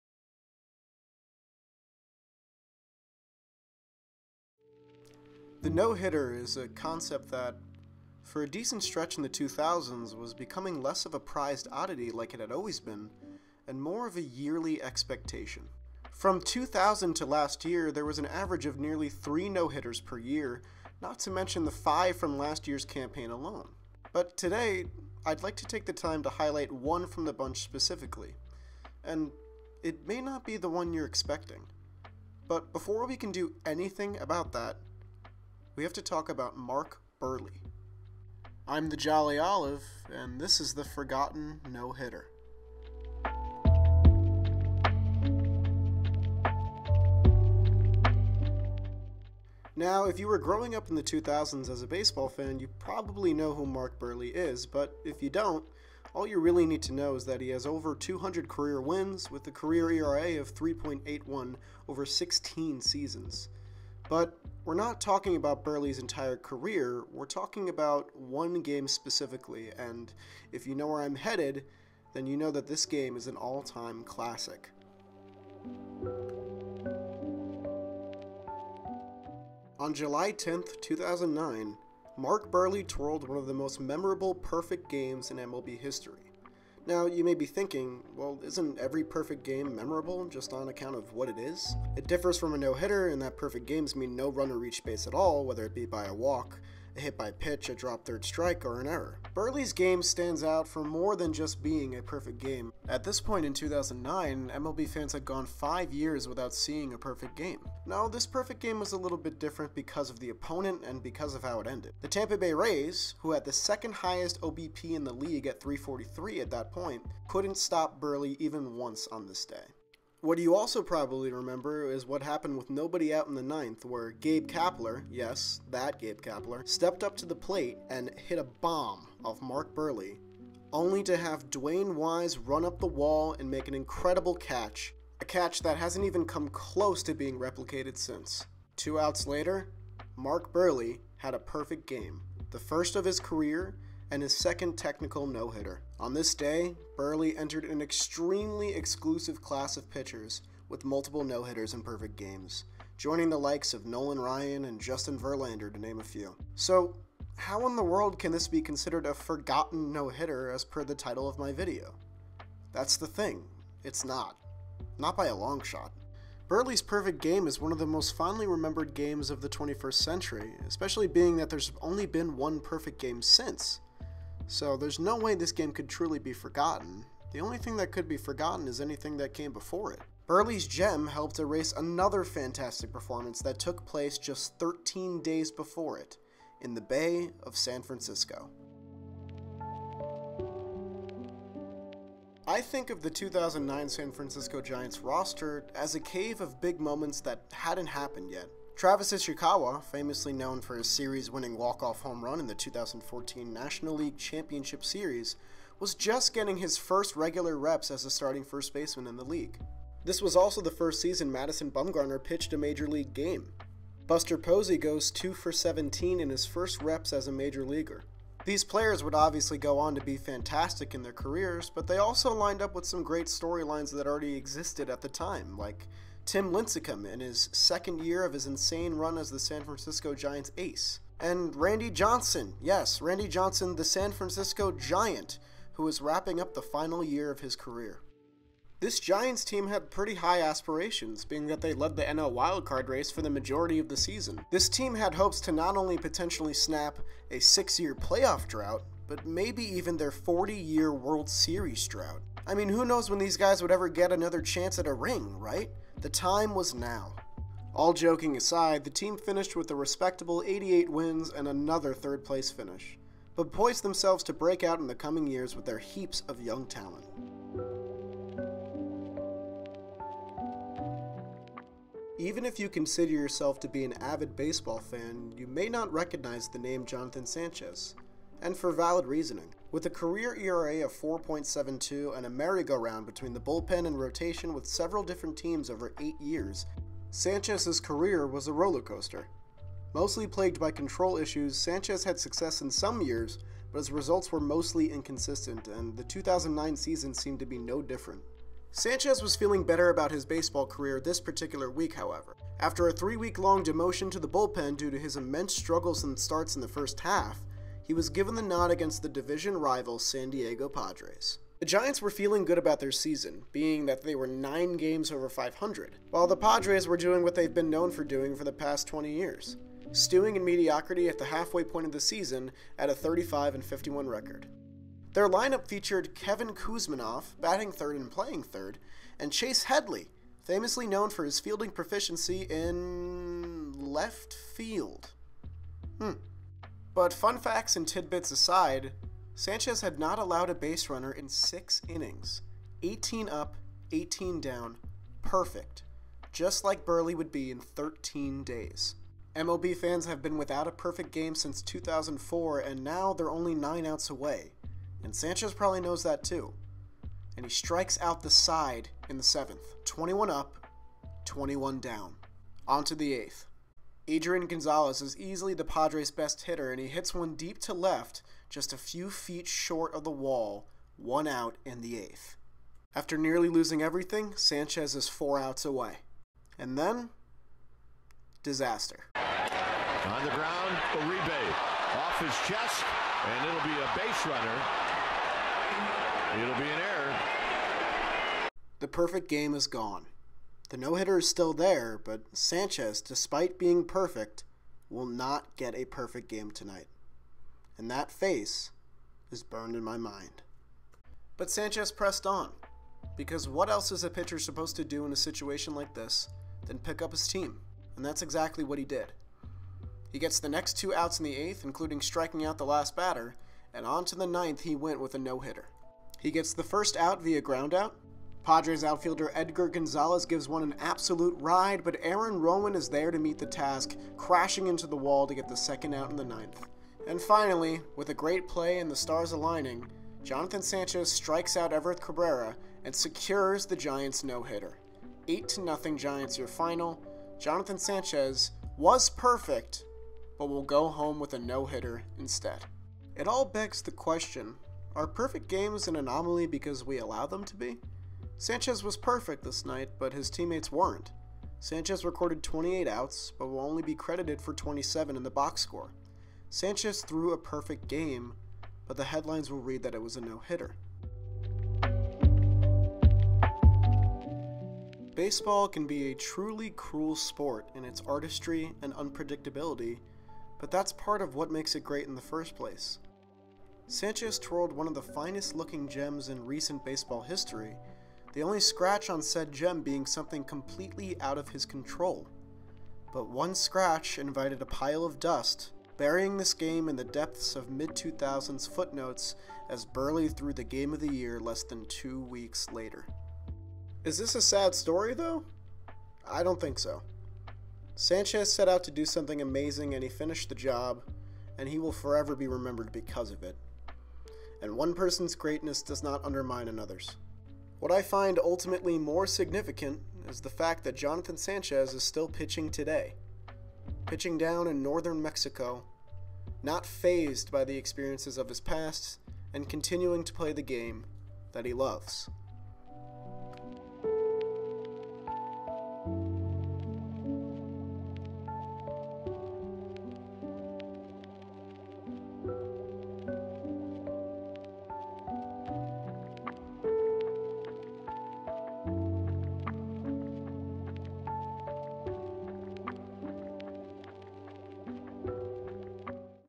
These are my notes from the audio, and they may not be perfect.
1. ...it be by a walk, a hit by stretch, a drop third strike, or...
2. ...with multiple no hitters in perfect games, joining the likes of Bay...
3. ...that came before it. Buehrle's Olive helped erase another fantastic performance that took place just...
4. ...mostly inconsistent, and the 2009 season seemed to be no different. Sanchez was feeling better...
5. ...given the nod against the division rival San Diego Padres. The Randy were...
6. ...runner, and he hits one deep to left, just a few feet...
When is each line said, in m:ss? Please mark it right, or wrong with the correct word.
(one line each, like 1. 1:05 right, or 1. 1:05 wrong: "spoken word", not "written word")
1. 1:35 wrong: "pitch", not "stretch"
2. 2:30 wrong: "Nolan", not "Bay"
3. 2:59 wrong: "Gem", not "Olive"
4. 4:54 right
5. 5:08 wrong: "Giants", not "Randy"
6. 6:06 wrong: "hitter", not "runner".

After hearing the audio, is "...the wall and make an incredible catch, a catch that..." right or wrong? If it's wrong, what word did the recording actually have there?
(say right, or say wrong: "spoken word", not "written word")
right.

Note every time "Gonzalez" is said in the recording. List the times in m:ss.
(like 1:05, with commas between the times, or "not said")
6:04, 6:59.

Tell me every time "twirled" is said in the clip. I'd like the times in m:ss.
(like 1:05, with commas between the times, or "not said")
1:22, 7:54.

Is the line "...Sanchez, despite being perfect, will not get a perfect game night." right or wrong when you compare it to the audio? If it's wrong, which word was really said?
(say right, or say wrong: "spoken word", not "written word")
wrong: "tonight", not "night".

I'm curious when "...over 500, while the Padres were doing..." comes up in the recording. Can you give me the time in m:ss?
5:15.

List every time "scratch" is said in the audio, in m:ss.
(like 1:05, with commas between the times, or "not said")
7:58, 8:03.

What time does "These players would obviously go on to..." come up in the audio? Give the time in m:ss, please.
3:38.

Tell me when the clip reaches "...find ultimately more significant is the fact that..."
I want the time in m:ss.
8:28.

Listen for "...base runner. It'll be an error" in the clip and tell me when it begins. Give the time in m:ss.
6:23.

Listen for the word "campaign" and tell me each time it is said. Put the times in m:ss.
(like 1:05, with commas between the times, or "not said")
0:22.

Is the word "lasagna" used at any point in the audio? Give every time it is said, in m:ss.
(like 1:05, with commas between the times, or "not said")
not said.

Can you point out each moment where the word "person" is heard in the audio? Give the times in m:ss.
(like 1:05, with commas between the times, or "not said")
8:24.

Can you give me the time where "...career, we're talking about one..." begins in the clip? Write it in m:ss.
1:06.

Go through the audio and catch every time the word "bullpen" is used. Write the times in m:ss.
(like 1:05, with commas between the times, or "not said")
4:43, 5:04.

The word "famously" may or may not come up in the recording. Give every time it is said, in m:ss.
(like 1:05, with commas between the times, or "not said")
3:19, 5:30.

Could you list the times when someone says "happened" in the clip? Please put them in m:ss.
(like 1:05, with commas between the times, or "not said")
2:02, 3:17.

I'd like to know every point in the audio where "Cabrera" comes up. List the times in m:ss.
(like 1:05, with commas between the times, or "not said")
7:11.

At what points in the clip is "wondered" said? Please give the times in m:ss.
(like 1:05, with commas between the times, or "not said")
not said.